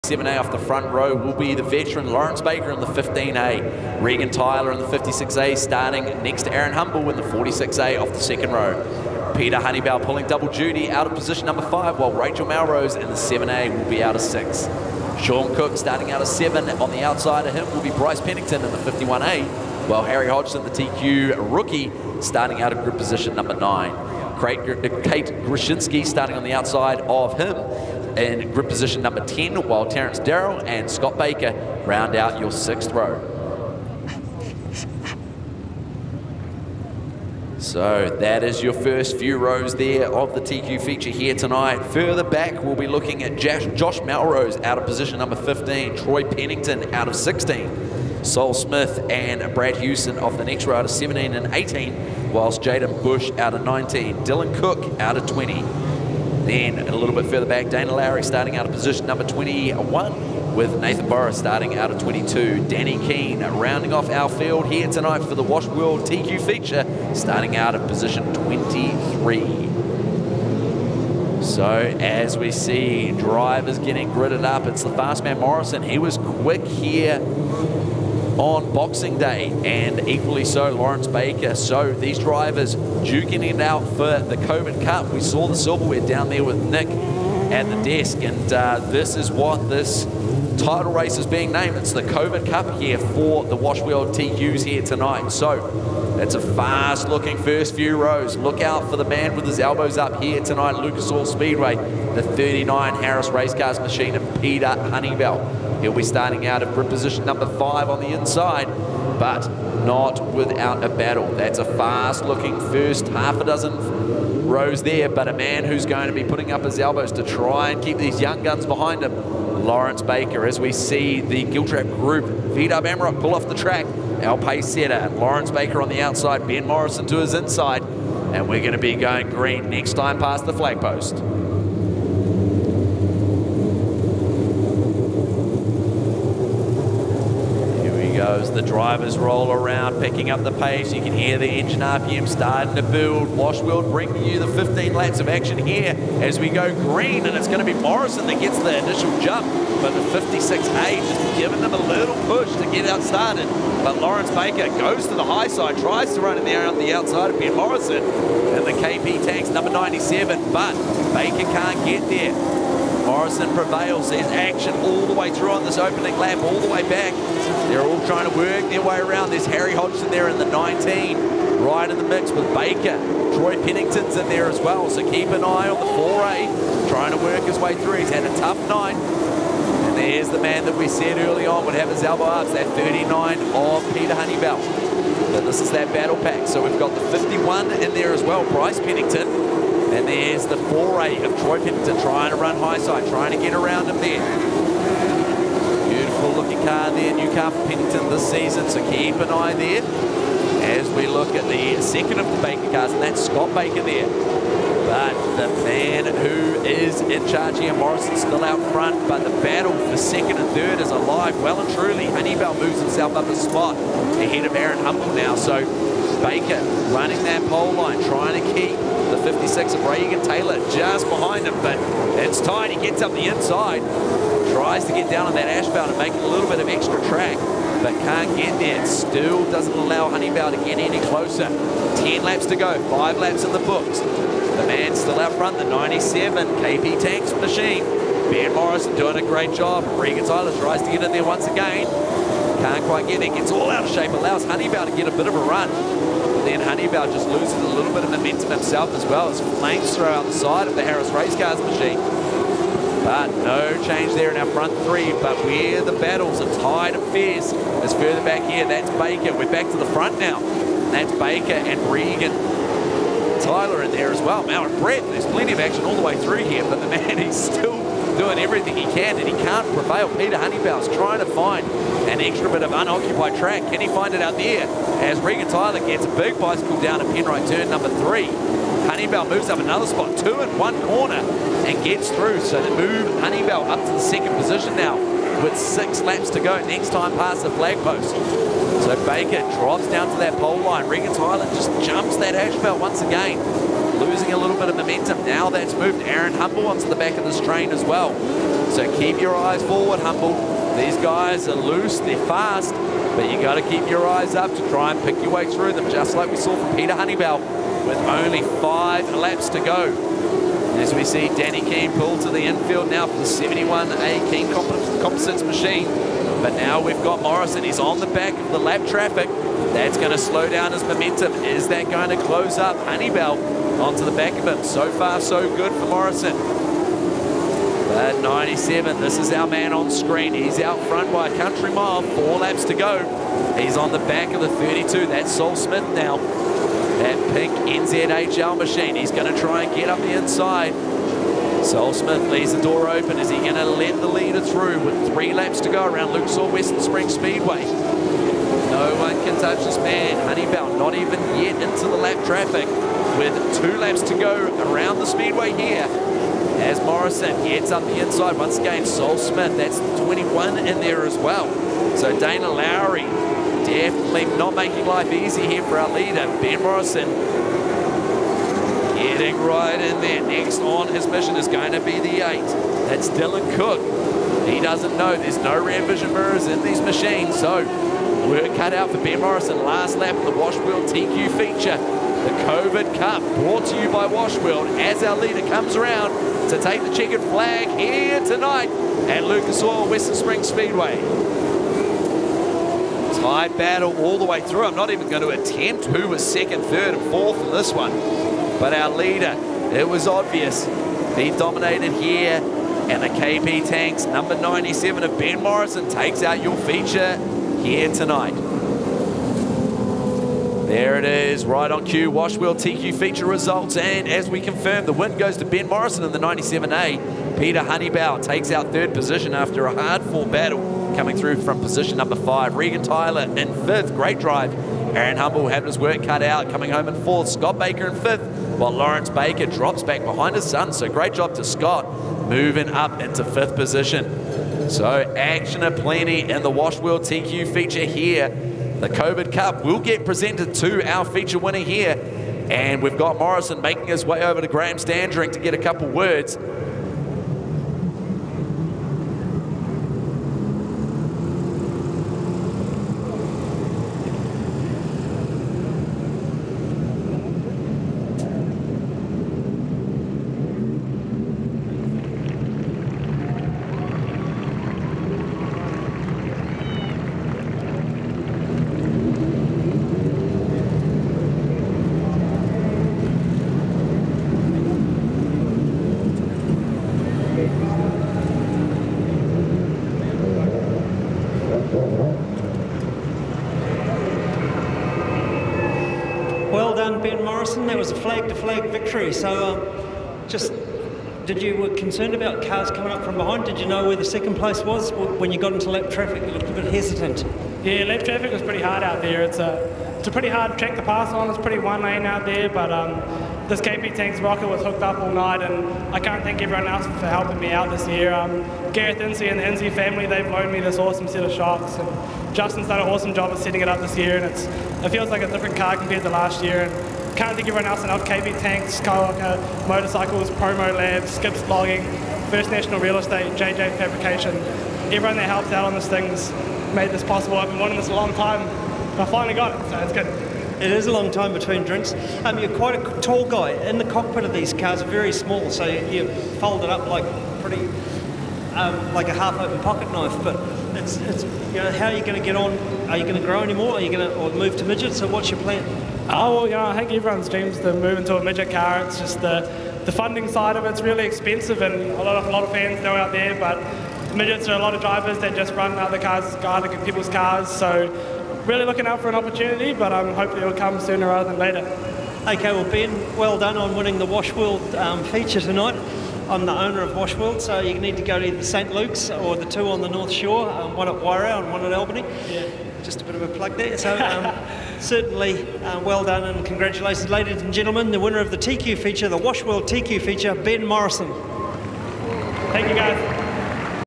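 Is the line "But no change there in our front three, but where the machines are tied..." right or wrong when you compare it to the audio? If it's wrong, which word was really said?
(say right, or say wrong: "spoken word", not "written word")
wrong: "battles", not "machines".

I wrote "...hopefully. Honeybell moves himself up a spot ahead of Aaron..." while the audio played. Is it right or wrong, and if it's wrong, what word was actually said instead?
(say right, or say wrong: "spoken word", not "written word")
wrong: "truly", not "hopefully".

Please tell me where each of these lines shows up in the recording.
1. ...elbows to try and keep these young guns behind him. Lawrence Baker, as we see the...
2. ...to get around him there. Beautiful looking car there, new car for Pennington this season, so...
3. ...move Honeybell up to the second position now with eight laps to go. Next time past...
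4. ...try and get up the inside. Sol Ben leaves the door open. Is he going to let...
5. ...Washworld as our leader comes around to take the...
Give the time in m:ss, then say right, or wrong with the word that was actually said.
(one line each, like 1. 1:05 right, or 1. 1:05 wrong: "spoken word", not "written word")
1. 1:56 right
2. 3:13 right
3. 4:42 wrong: "six", not "eight"
4. 5:39 wrong: "Smith", not "Ben"
5. 6:24 right.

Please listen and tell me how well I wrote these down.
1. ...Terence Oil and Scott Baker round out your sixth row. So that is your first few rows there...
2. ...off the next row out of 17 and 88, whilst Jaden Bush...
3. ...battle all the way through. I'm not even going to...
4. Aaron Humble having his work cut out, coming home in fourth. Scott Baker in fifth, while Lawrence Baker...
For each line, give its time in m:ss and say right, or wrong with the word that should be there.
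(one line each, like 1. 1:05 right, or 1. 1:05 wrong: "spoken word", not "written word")
1. 0:29 wrong: "Darrell", not "Oil"
2. 0:50 wrong: "18", not "88"
3. 6:33 right
4. 7:04 right.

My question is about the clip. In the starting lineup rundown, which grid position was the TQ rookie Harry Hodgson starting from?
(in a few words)
9.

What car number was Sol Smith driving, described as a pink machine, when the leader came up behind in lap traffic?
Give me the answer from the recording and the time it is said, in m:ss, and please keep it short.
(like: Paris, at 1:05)
32, at 5:34.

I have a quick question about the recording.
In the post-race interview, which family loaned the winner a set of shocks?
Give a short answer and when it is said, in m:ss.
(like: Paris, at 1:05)
Insey family, at 8:29.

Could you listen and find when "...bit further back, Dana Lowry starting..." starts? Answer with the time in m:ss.
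0:57.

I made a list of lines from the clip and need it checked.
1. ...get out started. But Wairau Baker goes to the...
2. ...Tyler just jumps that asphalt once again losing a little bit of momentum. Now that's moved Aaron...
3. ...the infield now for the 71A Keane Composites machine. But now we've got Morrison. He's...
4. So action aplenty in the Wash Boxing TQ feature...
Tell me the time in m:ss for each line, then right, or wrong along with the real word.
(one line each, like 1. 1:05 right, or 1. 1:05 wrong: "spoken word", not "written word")
1. 2:32 wrong: "Lawrence", not "Wairau"
2. 4:51 right
3. 5:12 right
4. 7:14 wrong: "World", not "Boxing".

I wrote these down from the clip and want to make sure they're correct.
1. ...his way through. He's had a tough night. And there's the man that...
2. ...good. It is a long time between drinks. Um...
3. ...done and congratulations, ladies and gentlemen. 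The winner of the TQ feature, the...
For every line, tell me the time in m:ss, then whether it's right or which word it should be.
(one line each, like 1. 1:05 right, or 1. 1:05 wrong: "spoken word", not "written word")
1. 2:57 right
2. 8:49 right
3. 9:36 right.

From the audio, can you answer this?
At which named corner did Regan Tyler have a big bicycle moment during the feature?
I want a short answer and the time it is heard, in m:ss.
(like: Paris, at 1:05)
Penrite turn number three, at 4:37.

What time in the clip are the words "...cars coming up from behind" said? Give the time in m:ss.
8:12.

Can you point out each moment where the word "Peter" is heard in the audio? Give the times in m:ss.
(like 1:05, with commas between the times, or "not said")
0:09, 1:44, 3:03, 4:30, 5:06, 6:57.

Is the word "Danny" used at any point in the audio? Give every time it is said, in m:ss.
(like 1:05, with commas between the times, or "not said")
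1:02, 5:11.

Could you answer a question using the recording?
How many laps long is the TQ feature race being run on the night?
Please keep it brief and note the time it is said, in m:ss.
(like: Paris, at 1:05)
15, at 2:24.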